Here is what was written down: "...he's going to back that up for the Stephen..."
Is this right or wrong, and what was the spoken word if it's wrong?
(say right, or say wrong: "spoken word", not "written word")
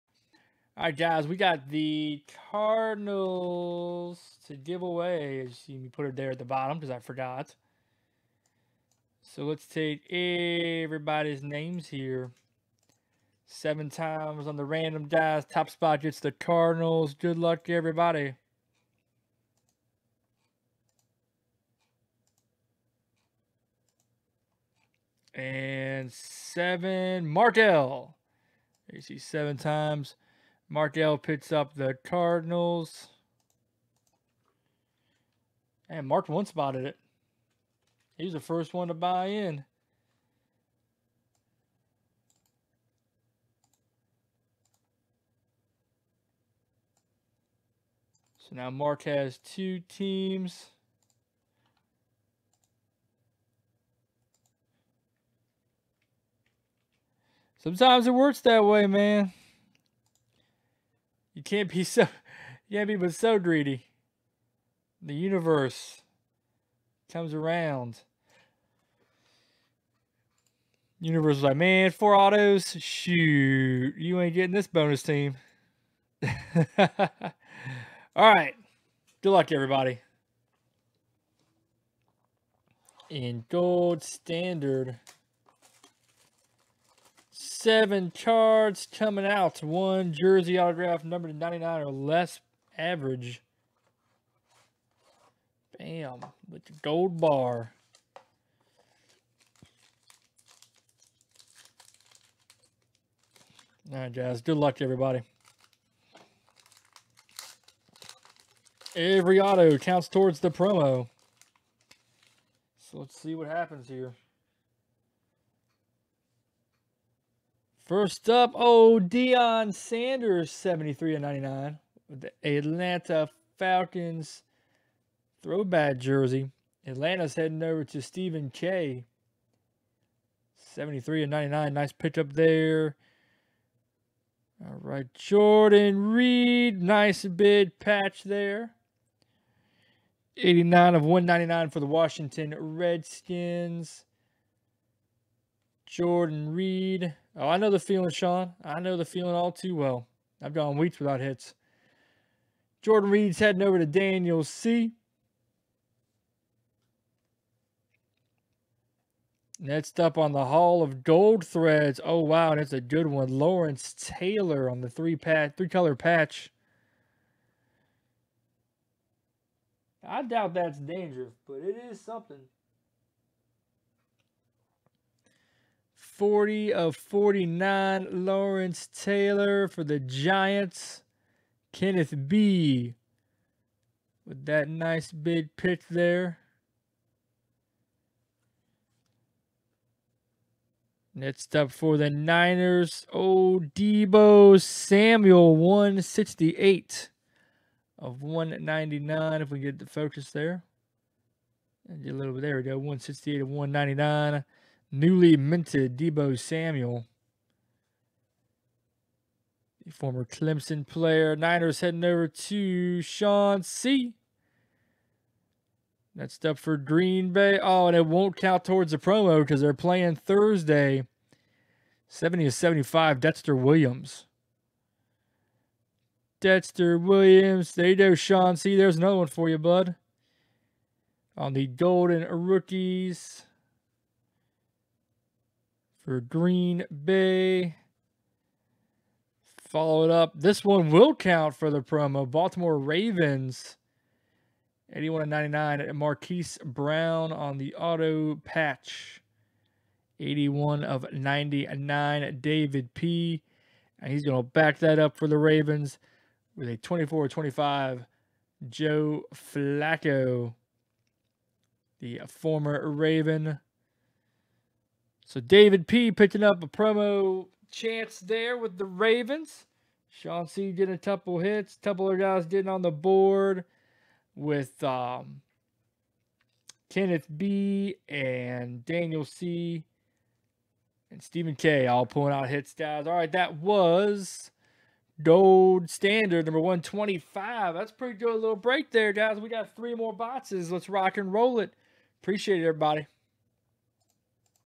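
wrong: "Ravens", not "Stephen".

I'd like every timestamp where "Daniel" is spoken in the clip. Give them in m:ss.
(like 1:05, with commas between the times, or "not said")
2:33, 4:38.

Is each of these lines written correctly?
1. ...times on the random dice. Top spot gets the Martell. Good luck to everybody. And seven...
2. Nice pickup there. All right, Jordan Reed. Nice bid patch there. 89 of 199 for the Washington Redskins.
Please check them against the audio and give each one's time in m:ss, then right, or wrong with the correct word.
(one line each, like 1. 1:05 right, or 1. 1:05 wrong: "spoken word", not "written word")
1. 0:13 wrong: "Cardinals", not "Martell"
2. 2:11 right.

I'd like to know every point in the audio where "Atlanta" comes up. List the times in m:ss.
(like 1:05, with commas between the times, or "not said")
2:02, 2:06.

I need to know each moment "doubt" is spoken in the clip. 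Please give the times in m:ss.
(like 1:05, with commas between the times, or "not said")
2:50.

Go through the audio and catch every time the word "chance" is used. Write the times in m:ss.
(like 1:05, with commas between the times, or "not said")
4:27.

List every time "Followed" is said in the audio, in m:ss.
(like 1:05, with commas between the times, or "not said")
3:59.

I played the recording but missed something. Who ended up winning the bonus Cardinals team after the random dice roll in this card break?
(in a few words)
Markel.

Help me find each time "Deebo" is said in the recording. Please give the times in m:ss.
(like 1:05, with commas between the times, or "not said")
3:13, 3:25.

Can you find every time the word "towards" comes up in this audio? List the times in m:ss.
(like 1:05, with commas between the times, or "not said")
1:50, 3:38.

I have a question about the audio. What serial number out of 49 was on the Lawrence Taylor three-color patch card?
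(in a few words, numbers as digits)
40.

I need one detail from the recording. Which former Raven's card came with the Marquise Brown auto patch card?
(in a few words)
Joe Flacco.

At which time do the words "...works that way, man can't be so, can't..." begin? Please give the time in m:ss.
0:58.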